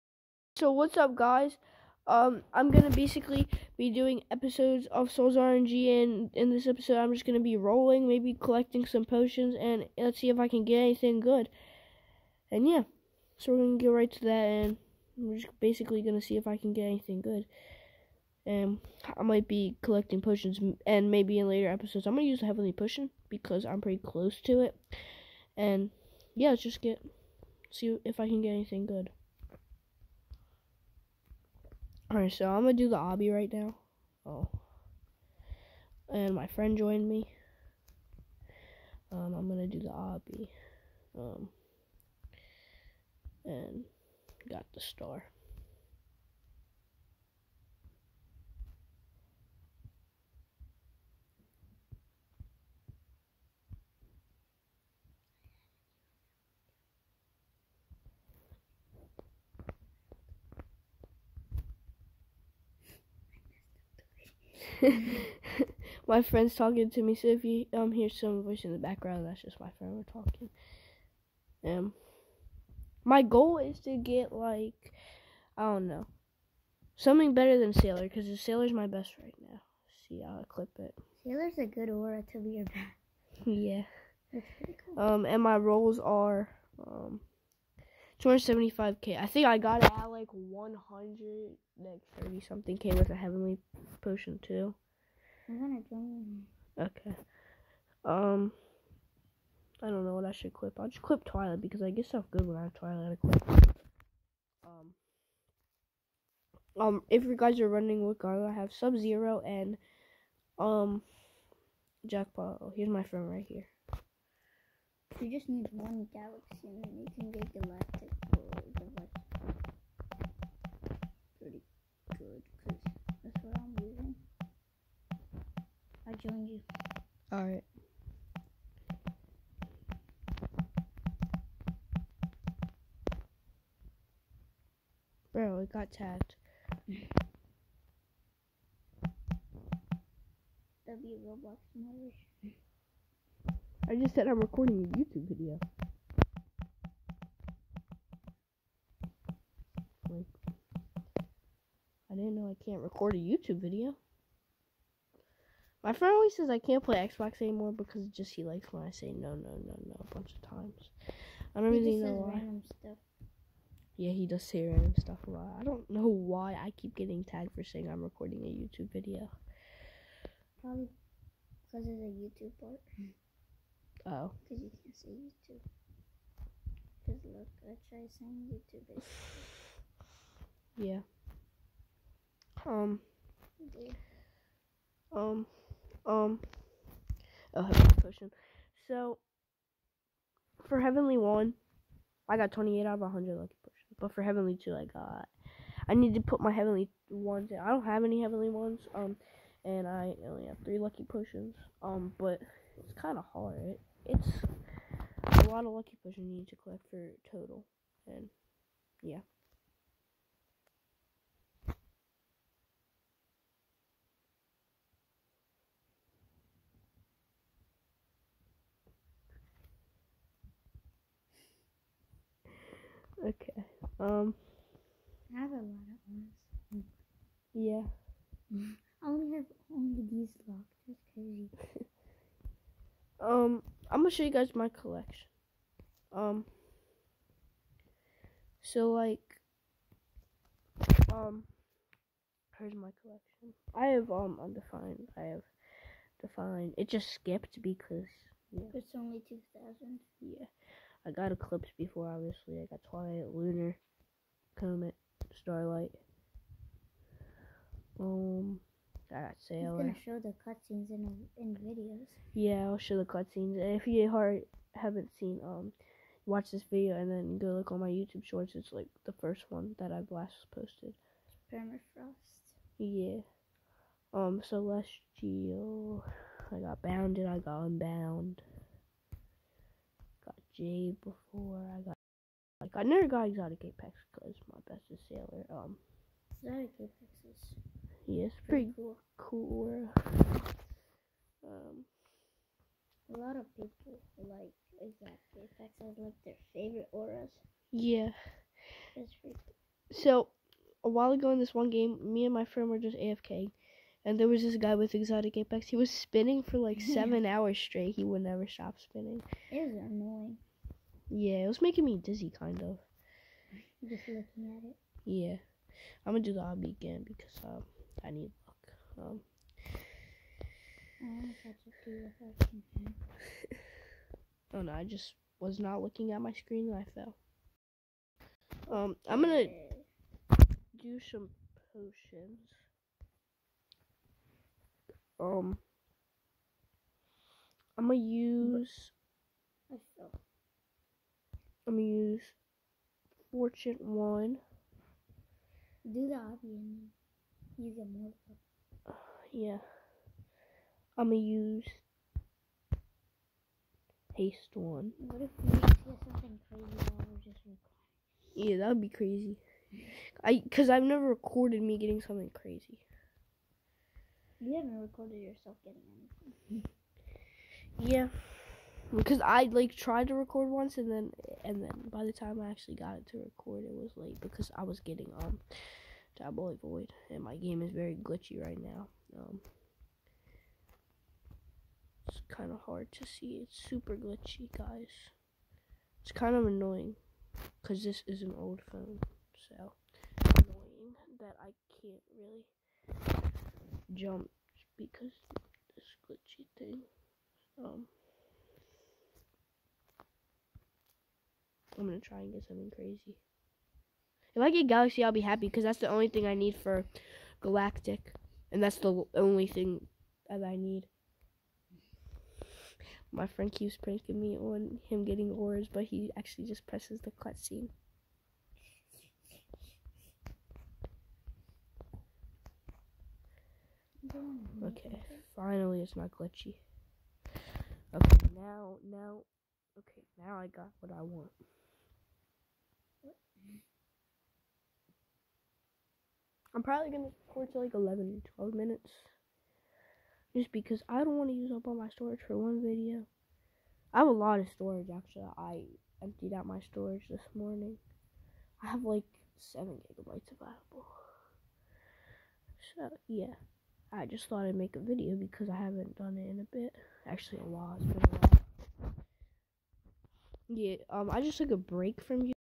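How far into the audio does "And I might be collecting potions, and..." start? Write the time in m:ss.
0:18.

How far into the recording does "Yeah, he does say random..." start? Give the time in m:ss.
2:43.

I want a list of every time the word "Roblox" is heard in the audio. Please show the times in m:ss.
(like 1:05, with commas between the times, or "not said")
2:21.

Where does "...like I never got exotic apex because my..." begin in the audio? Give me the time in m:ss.
4:42.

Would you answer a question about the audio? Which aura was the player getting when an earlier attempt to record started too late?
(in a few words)
Diabolic Void.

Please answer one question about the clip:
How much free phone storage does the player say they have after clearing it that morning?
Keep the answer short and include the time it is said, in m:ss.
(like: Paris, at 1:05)
7 gigabytes, at 7:29.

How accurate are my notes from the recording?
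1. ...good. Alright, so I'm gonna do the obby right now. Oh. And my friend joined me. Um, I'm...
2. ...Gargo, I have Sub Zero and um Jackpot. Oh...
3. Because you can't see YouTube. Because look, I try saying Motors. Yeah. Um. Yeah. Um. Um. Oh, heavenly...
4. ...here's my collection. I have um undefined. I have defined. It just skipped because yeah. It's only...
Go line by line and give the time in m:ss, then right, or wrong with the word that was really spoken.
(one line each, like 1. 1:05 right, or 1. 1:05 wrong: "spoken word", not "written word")
1. 0:28 right
2. 1:48 right
3. 2:54 wrong: "YouTube", not "Motors"
4. 4:02 right.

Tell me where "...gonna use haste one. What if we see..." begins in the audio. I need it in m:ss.
5:51.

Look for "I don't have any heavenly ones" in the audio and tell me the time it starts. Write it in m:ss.
3:17.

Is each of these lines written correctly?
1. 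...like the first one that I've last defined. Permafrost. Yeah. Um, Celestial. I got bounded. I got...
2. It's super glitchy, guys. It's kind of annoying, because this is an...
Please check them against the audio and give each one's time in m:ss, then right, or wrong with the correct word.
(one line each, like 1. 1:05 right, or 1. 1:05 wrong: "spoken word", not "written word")
1. 4:28 wrong: "posted", not "defined"
2. 6:23 right.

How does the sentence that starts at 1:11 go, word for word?
Um, my goal is to get like I don't know something better than Sailor because the Sailor's my best right now.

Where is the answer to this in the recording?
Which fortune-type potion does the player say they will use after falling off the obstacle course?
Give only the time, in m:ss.
5:43.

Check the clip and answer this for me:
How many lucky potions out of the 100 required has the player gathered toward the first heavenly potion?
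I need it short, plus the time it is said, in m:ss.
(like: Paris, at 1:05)
28, at 3:12.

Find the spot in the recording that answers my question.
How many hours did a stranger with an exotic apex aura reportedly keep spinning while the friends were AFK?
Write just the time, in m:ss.
5:06.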